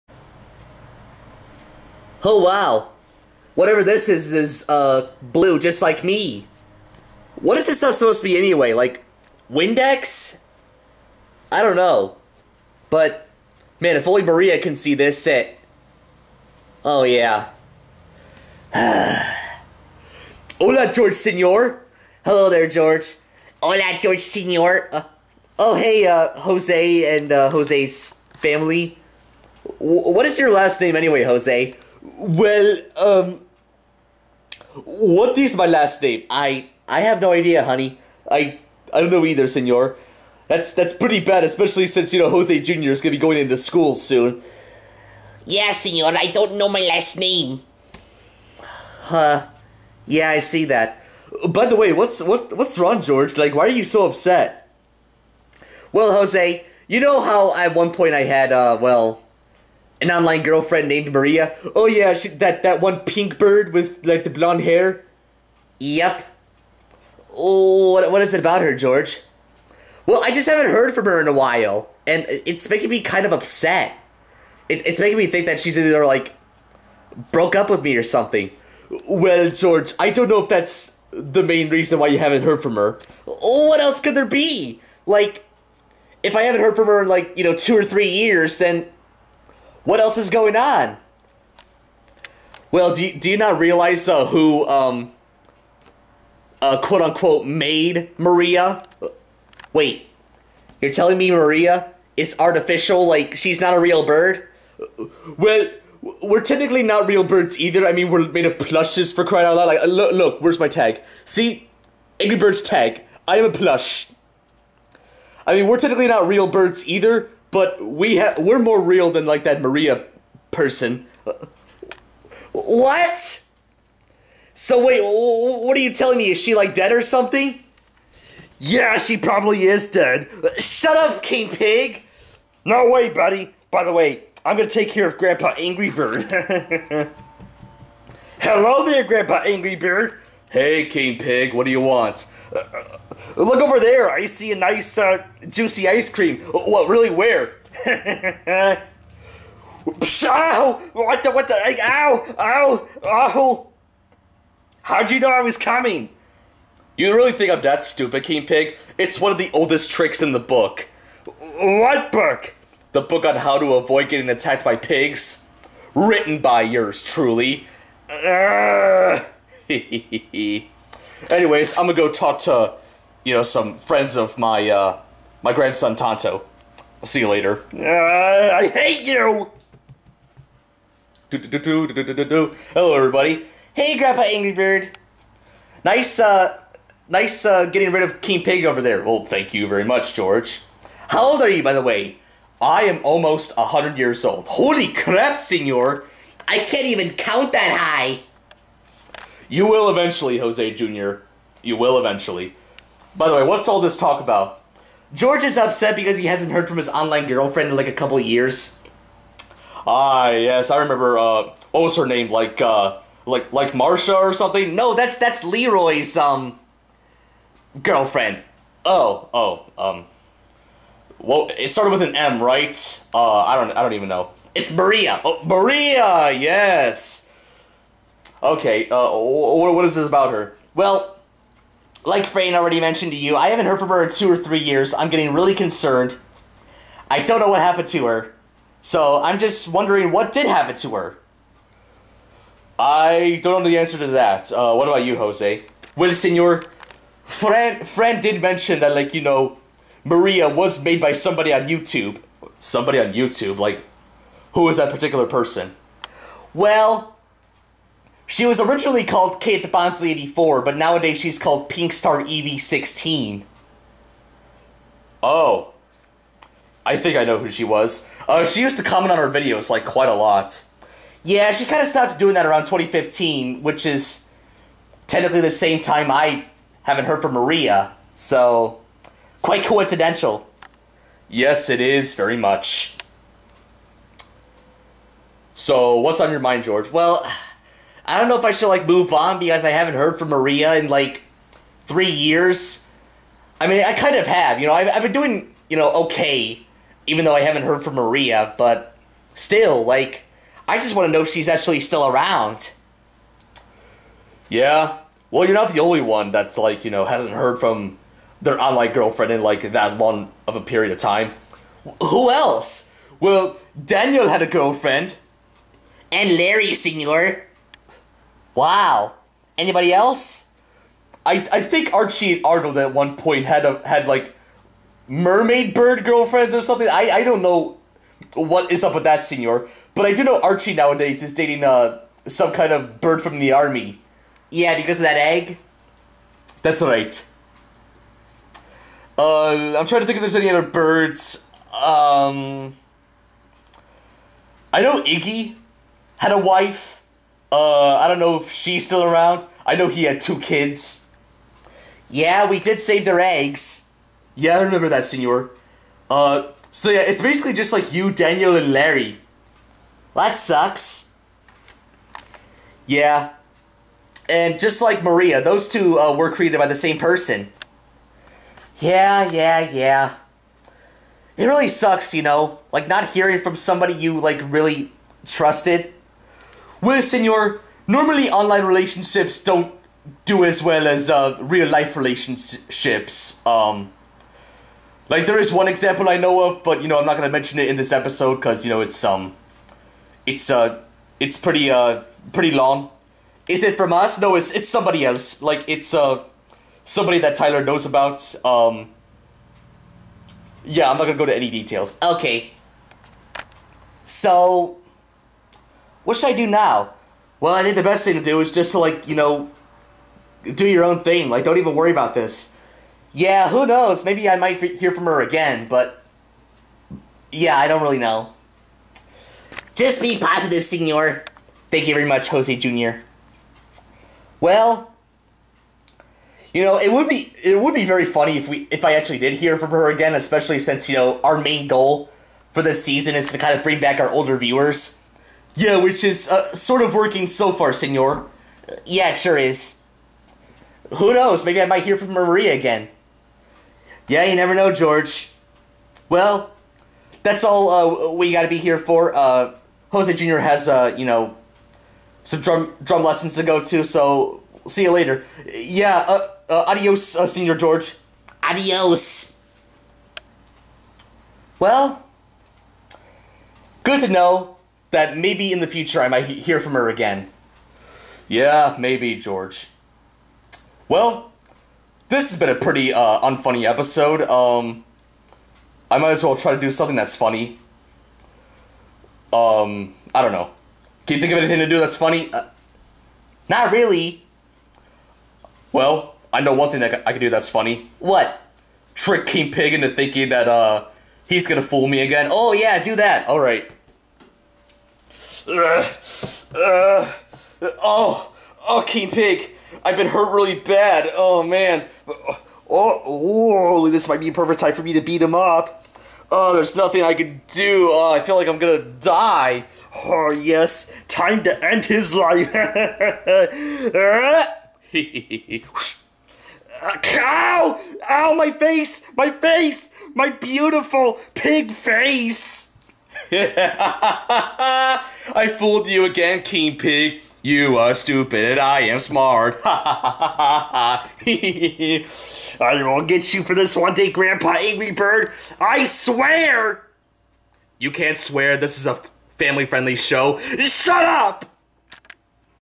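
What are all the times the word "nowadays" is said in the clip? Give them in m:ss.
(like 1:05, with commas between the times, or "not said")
4:20, 5:30.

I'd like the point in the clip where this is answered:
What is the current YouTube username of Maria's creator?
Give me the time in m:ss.
4:21.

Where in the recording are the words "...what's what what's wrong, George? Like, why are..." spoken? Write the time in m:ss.
0:51.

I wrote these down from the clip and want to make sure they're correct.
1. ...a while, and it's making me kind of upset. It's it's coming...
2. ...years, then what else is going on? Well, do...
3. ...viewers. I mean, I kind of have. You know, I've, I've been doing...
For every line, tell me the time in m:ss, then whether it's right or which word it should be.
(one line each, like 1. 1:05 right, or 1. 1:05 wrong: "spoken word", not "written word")
1. 1:11 wrong: "making", not "coming"
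2. 1:28 right
3. 4:52 wrong: "years", not "viewers".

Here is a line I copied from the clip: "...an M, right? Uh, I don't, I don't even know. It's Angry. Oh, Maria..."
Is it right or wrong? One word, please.
wrong.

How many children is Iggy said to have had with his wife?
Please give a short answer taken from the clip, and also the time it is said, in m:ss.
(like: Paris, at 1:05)
2, at 5:50.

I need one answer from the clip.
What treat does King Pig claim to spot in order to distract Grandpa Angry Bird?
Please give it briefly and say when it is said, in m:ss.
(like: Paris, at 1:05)
Ice cream, at 2:25.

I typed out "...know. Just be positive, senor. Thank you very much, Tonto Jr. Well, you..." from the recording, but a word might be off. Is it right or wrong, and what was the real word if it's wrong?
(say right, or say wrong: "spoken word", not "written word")
wrong: "Jose", not "Tonto".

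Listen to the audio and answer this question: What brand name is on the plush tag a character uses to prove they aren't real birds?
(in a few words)
Angry Birds.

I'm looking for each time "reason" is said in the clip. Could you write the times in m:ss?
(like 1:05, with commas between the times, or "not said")
1:21.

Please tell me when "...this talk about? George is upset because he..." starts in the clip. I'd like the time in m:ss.
3:23.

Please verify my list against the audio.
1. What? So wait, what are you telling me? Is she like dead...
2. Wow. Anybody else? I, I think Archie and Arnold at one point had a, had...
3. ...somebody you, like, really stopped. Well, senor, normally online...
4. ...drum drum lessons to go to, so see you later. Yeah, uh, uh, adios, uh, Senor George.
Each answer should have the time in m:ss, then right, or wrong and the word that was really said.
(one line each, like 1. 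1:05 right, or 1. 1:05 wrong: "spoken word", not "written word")
1. 2:02 right
2. 5:18 right
3. 6:13 wrong: "trusted", not "stopped"
4. 7:32 right.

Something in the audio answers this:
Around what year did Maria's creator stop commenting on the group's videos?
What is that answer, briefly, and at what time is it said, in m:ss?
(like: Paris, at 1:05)
2015, at 4:32.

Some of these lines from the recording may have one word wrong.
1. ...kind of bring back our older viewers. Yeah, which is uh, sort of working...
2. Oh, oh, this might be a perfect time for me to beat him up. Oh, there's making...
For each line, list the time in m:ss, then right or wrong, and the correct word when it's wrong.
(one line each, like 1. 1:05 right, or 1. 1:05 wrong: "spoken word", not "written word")
1. 7:13 right
2. 8:22 wrong: "nothing", not "making".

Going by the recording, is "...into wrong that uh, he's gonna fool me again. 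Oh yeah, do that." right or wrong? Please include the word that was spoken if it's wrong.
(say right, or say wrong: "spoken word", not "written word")
wrong: "thinking", not "wrong".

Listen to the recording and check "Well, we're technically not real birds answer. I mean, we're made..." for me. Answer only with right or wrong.
wrong.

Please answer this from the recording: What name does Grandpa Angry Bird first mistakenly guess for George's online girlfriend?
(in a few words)
Marsha.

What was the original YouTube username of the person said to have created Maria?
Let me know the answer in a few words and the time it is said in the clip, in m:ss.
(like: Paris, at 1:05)
Kate the Bonsley 84, at 4:19.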